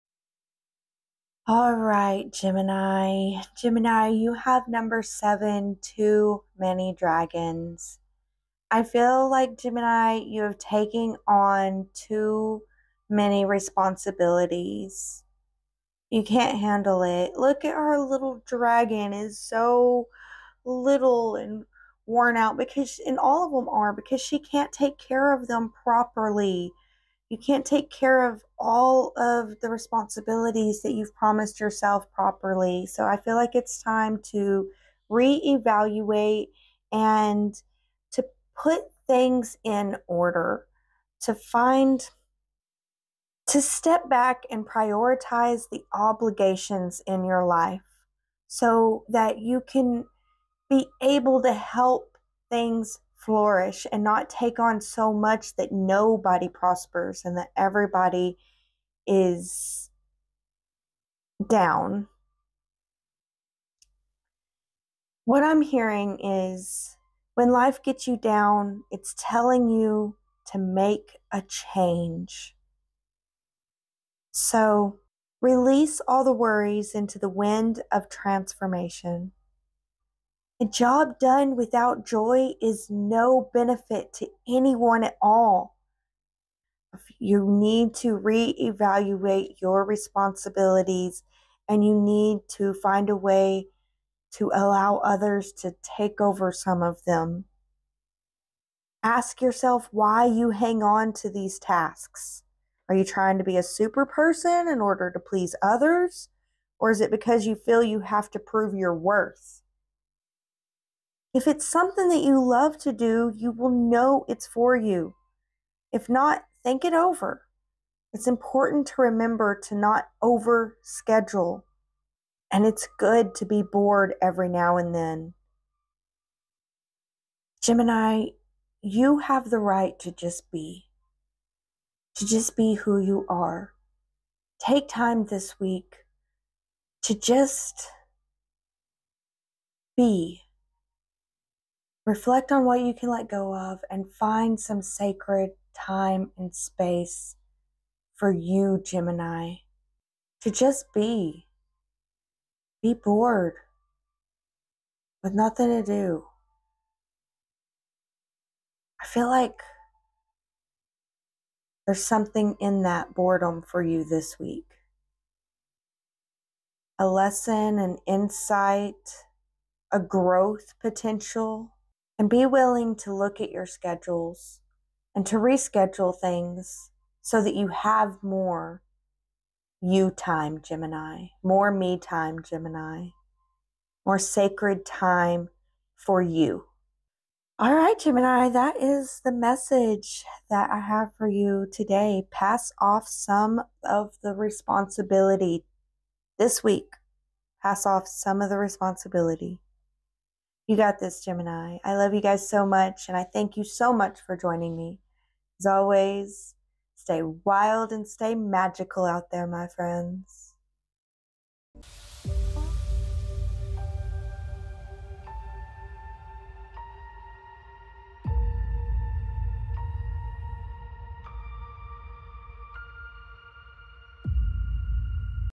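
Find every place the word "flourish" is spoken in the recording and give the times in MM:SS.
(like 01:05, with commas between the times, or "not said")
00:53.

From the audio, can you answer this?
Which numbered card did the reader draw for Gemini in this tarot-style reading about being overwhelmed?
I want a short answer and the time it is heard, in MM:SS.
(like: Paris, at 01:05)
7, at 00:05.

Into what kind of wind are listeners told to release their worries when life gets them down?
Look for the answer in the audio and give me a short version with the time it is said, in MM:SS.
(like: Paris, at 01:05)
The wind of transformation, at 01:17.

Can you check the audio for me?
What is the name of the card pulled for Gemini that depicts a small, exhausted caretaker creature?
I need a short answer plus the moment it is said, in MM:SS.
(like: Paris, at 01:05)
Too Many Dragons, at 00:05.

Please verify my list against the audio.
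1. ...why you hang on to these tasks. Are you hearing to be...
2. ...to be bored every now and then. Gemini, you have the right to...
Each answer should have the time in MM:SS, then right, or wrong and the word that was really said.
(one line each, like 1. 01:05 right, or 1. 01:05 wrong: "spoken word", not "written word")
1. 01:39 wrong: "trying", not "hearing"
2. 02:03 right.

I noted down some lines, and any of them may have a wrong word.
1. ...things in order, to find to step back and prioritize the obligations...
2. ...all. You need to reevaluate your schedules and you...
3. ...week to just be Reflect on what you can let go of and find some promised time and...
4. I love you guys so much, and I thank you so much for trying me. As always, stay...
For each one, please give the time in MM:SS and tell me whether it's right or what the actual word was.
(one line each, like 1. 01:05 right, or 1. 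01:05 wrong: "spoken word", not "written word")
1. 00:39 right
2. 01:25 wrong: "responsibilities", not "schedules"
3. 02:15 wrong: "sacred", not "promised"
4. 03:21 wrong: "joining", not "trying".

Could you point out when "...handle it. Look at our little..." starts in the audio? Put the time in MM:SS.
00:16.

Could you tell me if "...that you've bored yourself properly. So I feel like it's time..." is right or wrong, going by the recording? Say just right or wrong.
wrong.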